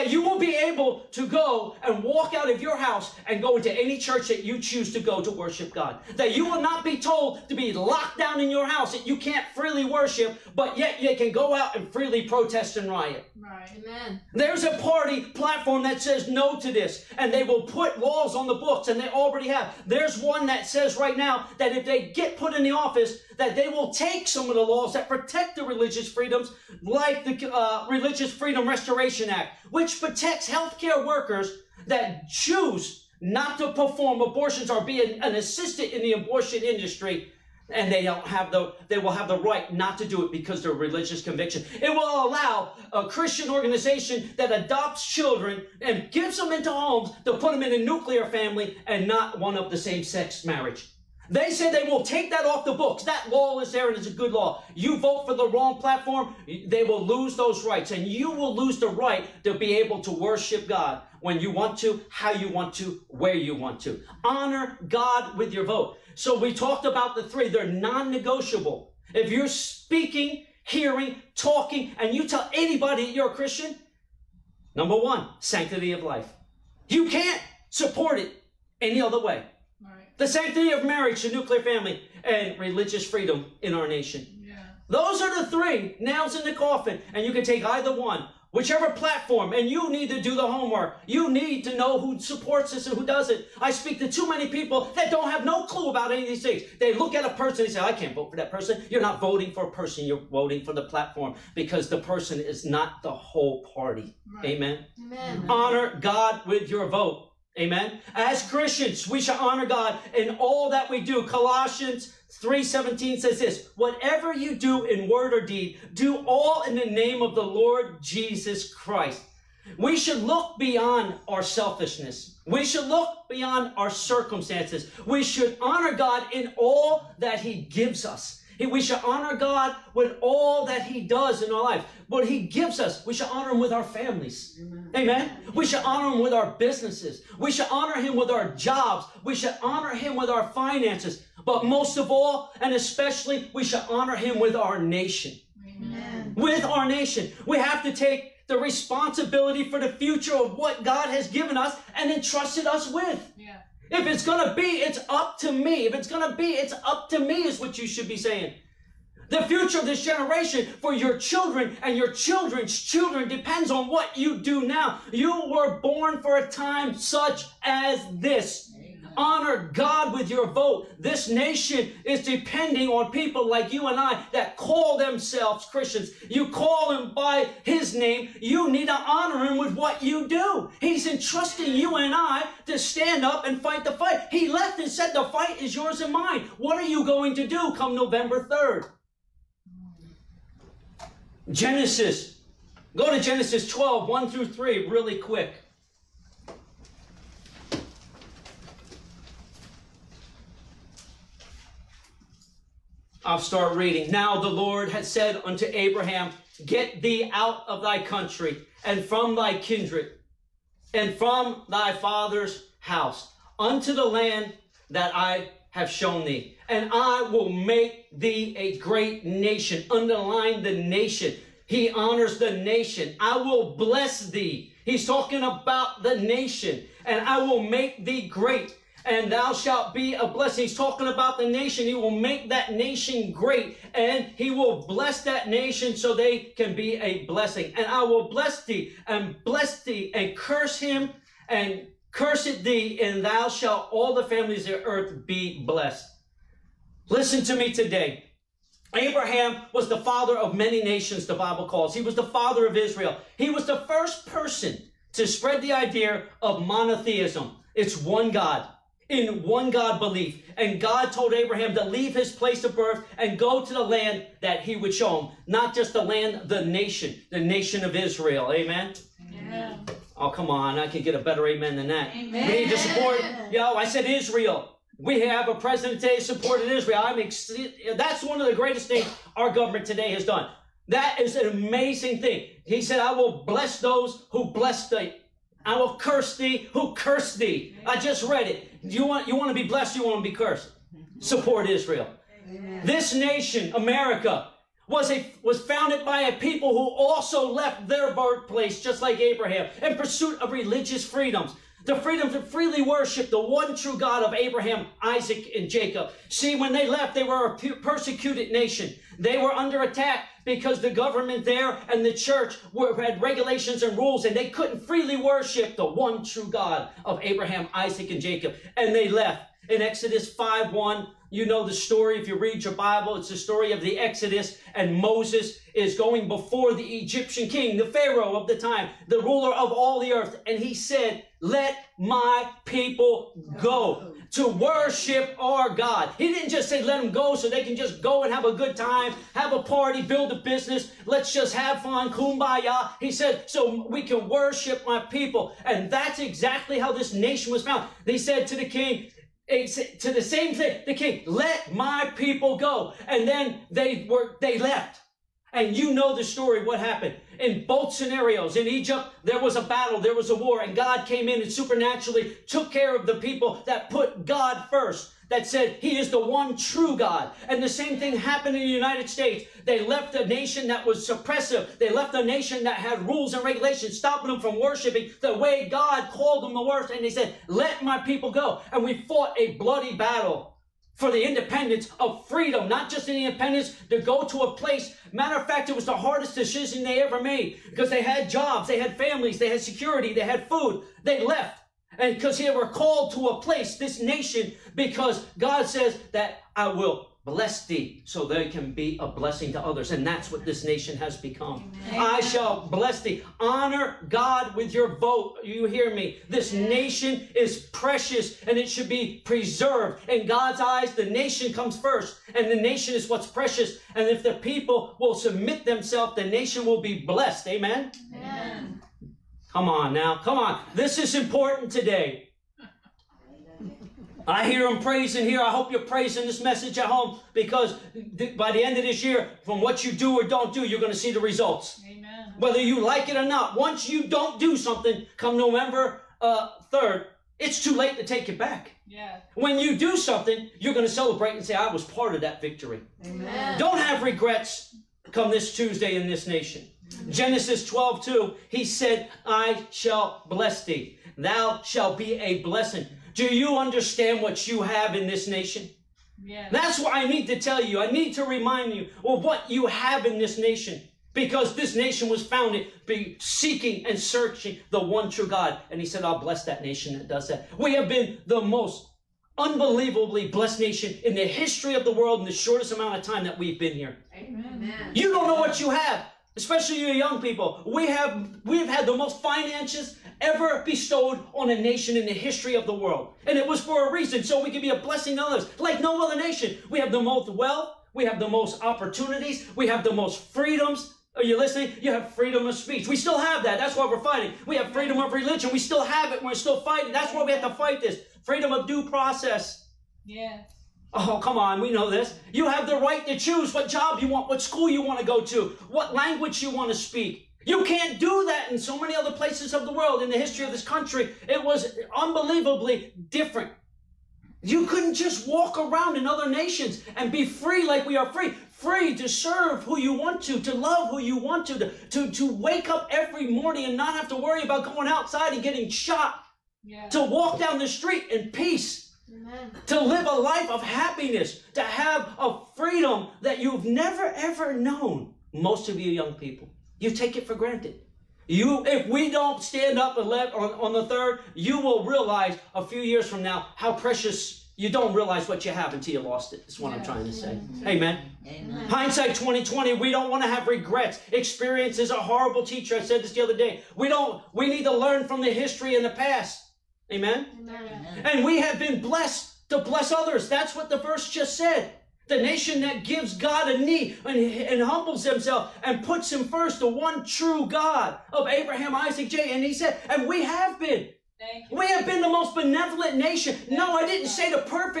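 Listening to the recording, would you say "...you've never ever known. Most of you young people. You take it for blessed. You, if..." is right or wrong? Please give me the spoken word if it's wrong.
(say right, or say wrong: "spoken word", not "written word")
wrong: "granted", not "blessed".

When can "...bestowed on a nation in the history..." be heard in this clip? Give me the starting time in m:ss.
8:00.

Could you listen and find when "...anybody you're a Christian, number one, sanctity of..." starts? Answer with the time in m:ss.
1:12.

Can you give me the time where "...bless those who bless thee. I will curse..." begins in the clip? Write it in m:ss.
4:43.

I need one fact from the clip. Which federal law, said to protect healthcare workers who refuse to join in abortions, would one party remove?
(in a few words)
Religious Freedom Restoration Act.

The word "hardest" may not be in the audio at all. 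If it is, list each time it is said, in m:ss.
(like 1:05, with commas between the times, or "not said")
6:25.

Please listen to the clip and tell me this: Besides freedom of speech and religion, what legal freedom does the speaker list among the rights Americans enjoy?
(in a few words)
Due process.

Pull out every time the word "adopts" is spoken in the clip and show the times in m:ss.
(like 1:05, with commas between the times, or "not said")
0:44.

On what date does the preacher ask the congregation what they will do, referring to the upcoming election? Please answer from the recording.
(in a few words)
November 3rd.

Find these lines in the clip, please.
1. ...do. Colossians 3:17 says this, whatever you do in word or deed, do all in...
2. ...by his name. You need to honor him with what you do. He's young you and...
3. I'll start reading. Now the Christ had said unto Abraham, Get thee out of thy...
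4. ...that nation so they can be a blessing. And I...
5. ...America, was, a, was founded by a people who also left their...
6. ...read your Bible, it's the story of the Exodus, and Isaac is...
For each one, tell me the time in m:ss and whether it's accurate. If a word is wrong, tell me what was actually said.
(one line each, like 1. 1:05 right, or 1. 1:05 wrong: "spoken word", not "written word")
1. 1:51 right
2. 2:57 wrong: "entrusting", not "young"
3. 3:23 wrong: "Lord", not "Christ"
4. 3:55 right
5. 4:53 right
6. 5:22 wrong: "Moses", not "Isaac".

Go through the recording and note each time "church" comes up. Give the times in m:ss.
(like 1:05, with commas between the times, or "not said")
0:03, 5:12.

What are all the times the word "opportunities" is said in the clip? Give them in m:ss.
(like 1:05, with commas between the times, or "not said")
8:08.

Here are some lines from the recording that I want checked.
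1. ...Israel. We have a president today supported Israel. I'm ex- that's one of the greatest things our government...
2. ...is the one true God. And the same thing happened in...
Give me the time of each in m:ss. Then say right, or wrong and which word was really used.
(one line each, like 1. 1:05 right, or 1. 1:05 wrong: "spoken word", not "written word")
1. 4:34 right
2. 6:05 right.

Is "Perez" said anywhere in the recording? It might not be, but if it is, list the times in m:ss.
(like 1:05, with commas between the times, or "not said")
not said.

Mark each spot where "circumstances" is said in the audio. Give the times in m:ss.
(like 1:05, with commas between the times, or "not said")
2:03.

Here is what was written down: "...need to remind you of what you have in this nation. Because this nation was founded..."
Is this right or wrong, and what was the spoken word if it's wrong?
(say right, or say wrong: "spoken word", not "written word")
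right.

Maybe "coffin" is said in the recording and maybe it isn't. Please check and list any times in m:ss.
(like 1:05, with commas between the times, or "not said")
1:26.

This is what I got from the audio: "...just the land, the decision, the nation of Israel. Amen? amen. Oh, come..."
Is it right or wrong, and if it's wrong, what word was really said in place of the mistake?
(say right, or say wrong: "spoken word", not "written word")
wrong: "nation", not "decision".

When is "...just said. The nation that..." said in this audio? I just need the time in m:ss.
9:21.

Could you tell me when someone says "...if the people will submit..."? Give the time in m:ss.
6:54.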